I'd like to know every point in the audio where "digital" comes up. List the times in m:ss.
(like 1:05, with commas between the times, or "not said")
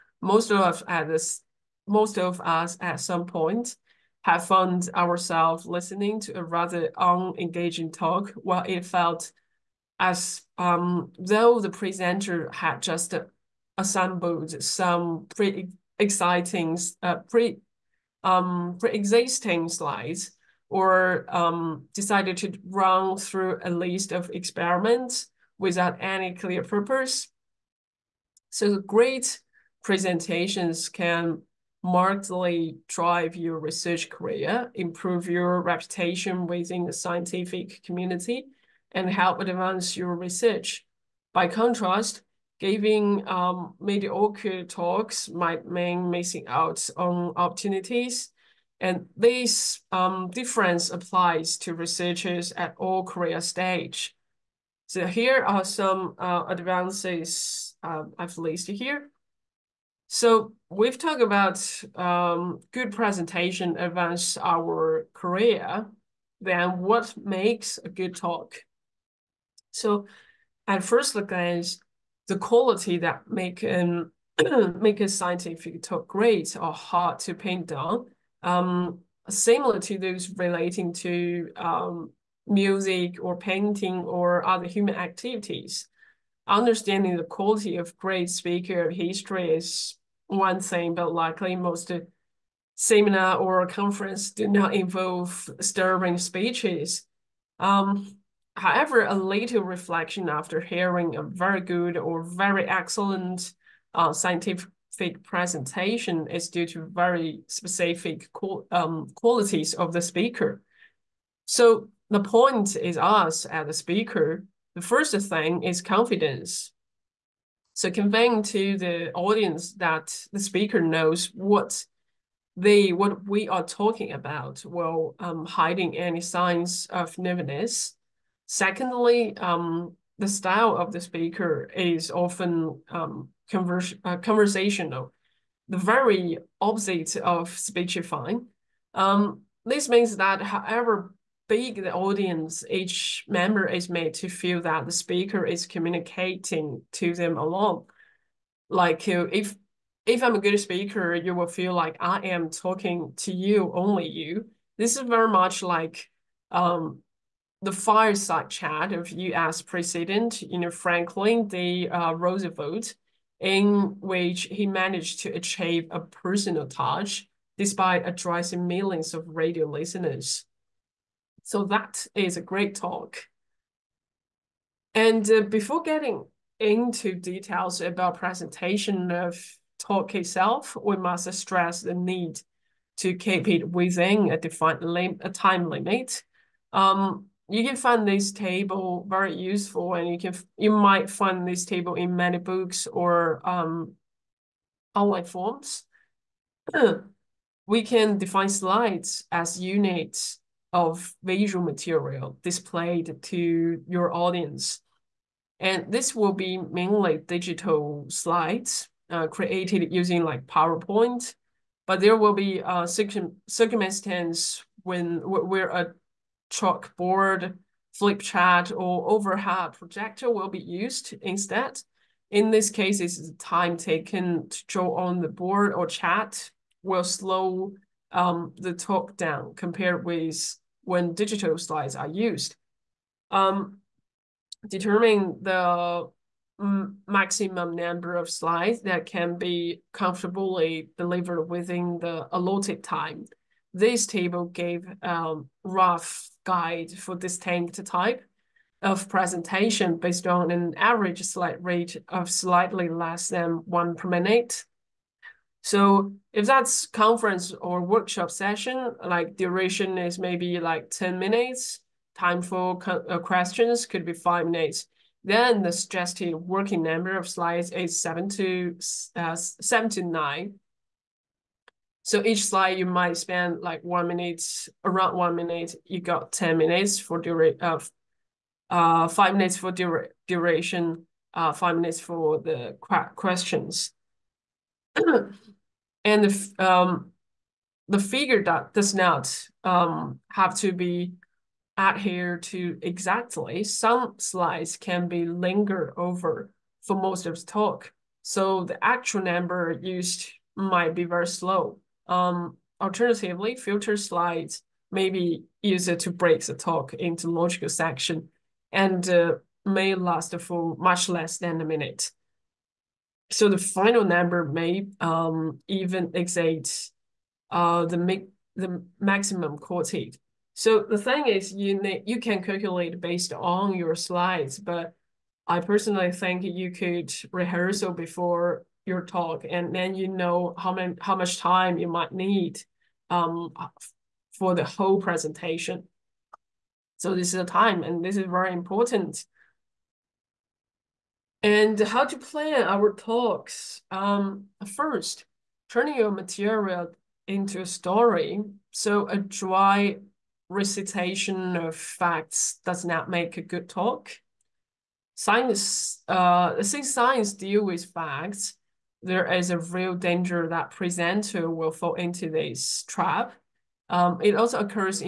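3:27, 3:51.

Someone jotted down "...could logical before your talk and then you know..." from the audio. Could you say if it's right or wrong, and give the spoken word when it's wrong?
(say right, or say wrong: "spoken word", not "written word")
wrong: "rehearsal", not "logical".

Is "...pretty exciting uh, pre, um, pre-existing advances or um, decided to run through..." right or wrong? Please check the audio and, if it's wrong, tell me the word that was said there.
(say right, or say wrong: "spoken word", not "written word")
wrong: "slides", not "advances".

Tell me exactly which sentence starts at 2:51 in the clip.
So that is a great talk.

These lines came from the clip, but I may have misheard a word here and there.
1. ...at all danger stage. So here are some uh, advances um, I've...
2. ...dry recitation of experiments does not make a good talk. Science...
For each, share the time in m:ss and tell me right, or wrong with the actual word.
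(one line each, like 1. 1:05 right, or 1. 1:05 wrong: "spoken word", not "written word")
1. 0:52 wrong: "career", not "danger"
2. 5:49 wrong: "facts", not "experiments".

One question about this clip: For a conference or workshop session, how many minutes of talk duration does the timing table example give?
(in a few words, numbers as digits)
10.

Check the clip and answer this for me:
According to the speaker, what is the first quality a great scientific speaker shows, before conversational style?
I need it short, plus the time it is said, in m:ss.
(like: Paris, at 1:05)
Confidence, at 1:55.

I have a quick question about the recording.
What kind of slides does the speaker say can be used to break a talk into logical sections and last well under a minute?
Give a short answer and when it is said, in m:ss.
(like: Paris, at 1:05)
Filter slides, at 5:03.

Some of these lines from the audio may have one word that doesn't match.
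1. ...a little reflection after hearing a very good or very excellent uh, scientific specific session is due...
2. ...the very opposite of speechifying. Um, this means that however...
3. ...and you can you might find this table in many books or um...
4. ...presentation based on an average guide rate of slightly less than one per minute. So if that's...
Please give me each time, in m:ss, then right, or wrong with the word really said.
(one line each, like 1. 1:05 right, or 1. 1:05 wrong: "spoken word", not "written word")
1. 1:39 wrong: "presentation", not "session"
2. 2:15 right
3. 3:09 right
4. 4:09 wrong: "slide", not "guide".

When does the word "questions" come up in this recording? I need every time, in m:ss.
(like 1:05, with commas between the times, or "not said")
4:23, 4:43.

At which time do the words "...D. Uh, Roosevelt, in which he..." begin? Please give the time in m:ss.
2:41.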